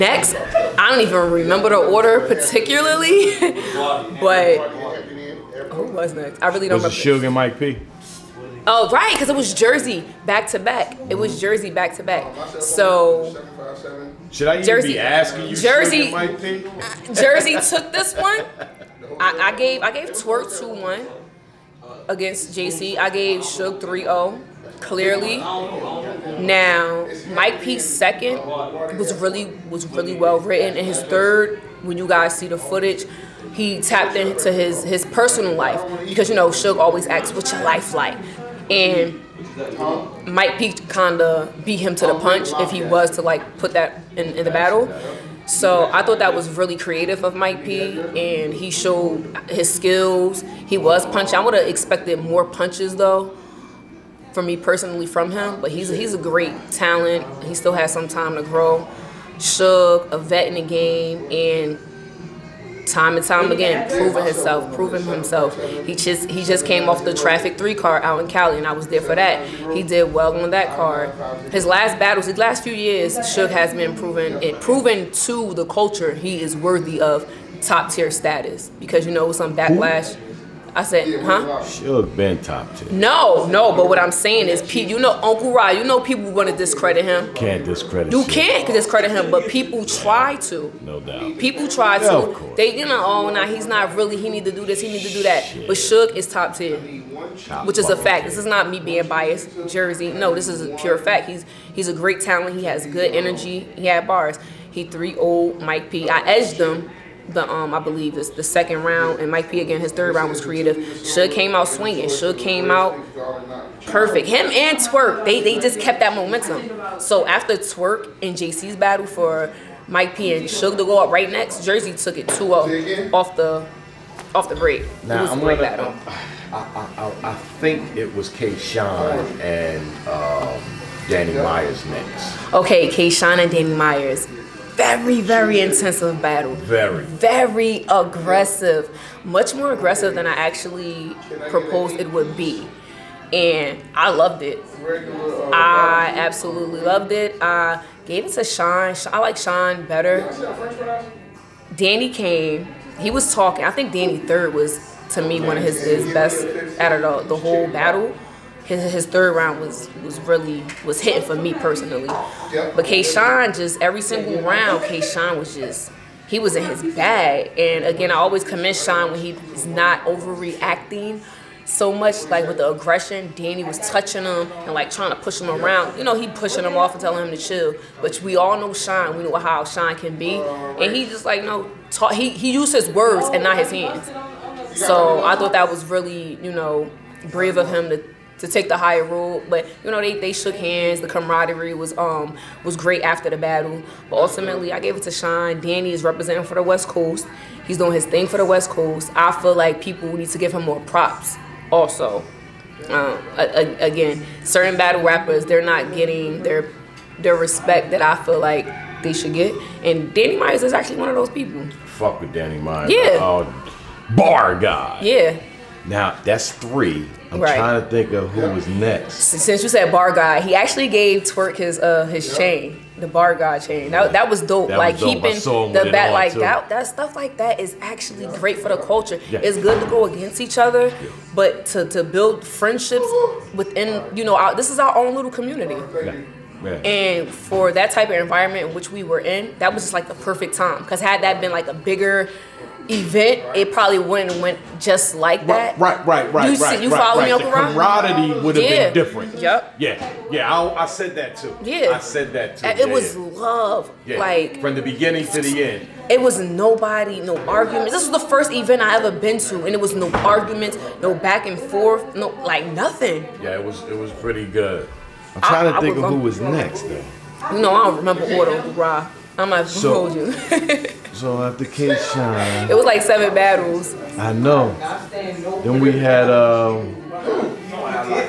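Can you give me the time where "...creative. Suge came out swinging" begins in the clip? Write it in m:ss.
1:50.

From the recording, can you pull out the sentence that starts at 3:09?
But you know, they, they shook hands.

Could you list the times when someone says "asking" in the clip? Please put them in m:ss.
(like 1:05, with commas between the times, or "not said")
0:14.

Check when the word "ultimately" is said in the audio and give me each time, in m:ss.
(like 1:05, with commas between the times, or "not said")
3:14.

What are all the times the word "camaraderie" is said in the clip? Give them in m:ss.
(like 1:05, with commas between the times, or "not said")
3:11, 4:08.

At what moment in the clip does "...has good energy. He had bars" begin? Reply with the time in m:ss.
1:42.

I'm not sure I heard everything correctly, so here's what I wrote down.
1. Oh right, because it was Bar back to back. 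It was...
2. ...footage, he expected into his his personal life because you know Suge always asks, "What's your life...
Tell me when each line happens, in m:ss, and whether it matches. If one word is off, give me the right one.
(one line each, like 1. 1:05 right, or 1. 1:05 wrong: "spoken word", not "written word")
1. 0:08 wrong: "Jersey", not "Bar"
2. 0:32 wrong: "tapped", not "expected".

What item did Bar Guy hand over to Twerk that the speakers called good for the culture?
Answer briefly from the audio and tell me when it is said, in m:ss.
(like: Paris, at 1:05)
Bar Guy chain, at 3:42.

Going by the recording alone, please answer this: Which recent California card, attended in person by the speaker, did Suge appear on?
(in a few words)
Traffic Three.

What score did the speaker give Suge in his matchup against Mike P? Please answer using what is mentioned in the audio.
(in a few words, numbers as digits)
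3-0.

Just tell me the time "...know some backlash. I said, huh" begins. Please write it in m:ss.
1:19.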